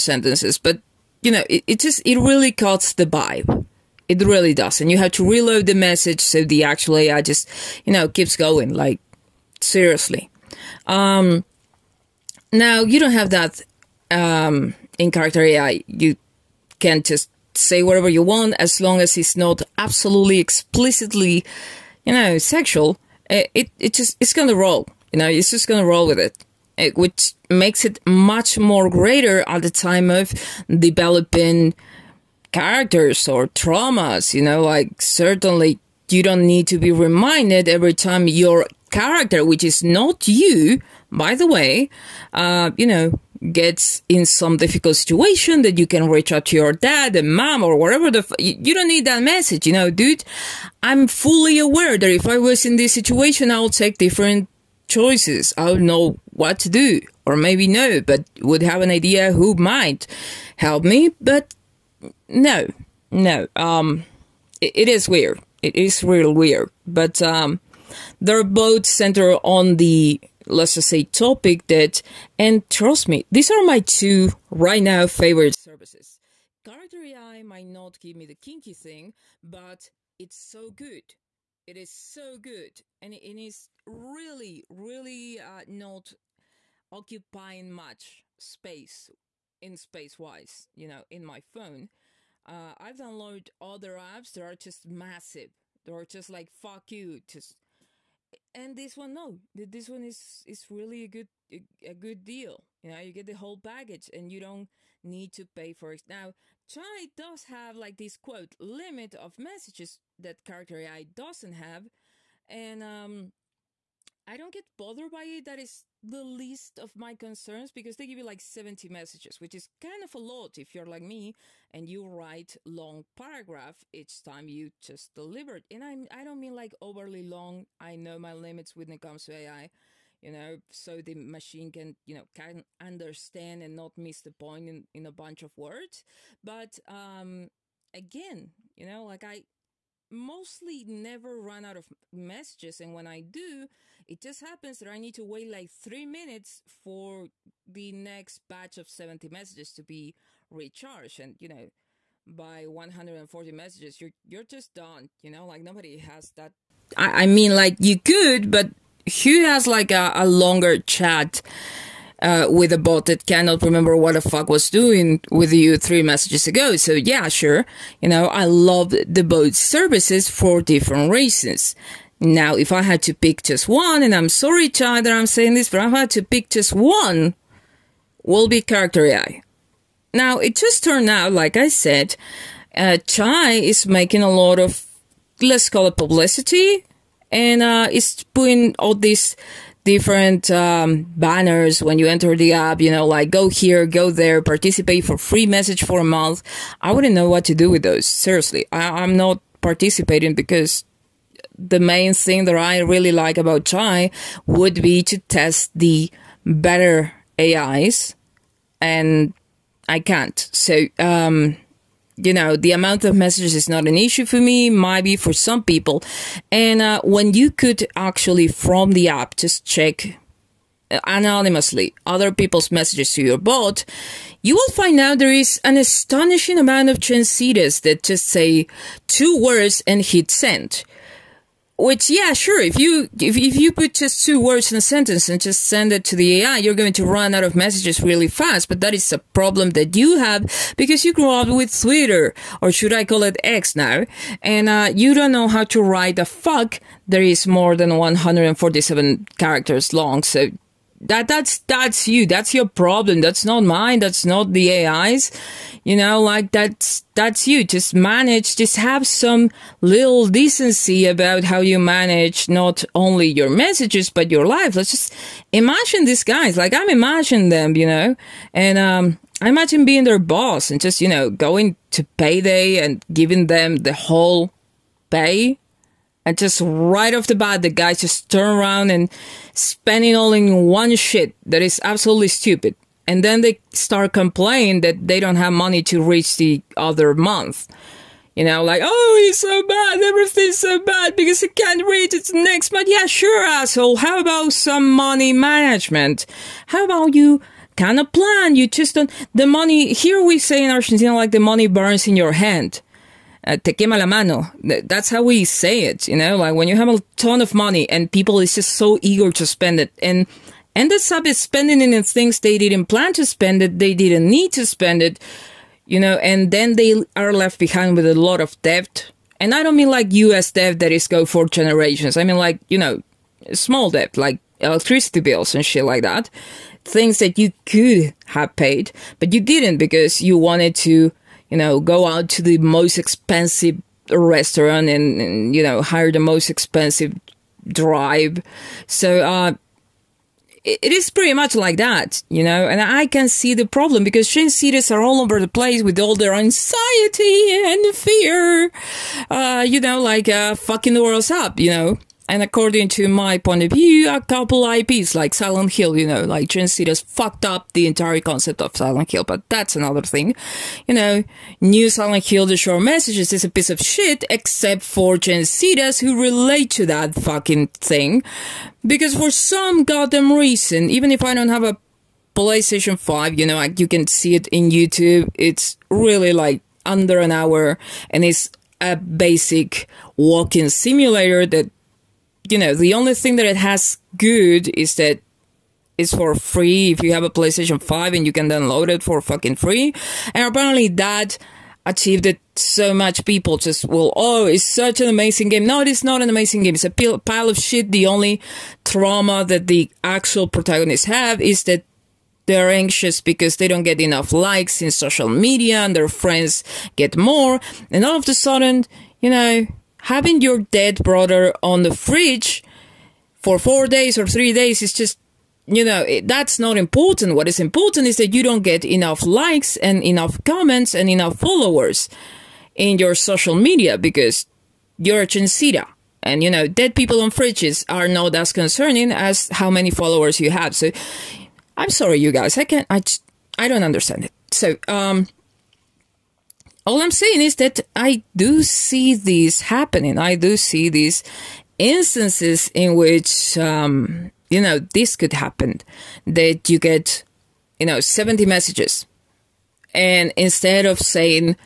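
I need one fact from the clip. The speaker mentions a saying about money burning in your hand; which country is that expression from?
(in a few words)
Argentina.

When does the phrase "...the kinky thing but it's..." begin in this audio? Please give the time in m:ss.
1:18.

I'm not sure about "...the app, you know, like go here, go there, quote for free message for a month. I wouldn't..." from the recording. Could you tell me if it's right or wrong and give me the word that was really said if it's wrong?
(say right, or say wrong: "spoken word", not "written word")
wrong: "participate", not "quote".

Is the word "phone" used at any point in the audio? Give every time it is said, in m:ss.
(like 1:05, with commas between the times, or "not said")
1:31.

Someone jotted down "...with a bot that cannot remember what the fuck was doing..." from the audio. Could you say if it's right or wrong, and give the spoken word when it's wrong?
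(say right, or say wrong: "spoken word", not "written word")
right.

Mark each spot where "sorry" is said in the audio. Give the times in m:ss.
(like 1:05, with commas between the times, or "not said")
2:54, 7:11.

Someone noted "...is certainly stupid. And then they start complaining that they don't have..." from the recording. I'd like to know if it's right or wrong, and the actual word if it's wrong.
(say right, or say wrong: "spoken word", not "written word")
wrong: "absolutely", not "certainly".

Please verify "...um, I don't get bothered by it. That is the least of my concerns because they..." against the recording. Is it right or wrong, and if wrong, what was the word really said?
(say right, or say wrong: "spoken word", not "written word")
right.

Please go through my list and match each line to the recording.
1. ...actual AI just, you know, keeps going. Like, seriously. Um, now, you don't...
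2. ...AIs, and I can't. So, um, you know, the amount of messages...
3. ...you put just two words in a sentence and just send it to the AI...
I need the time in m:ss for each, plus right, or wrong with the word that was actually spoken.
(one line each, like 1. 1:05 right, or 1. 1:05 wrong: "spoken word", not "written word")
1. 0:06 right
2. 3:27 right
3. 3:53 right.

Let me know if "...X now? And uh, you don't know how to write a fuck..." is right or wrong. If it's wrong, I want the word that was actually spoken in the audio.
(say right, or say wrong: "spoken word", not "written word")
right.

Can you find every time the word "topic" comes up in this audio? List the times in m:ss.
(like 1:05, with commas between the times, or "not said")
1:11.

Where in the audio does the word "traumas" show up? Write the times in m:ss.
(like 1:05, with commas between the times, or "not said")
0:33, 6:38.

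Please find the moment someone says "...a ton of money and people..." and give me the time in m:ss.
5:06.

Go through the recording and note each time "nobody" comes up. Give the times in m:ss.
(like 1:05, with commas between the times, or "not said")
2:35.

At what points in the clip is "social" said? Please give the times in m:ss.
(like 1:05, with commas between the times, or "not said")
6:44, 7:03.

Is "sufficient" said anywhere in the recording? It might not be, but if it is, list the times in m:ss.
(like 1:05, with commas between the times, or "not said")
not said.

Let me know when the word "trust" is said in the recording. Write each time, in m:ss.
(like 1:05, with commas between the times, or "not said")
1:12.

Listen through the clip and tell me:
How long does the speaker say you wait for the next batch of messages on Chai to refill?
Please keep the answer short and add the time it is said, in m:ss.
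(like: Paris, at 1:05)
three minutes, at 2:25.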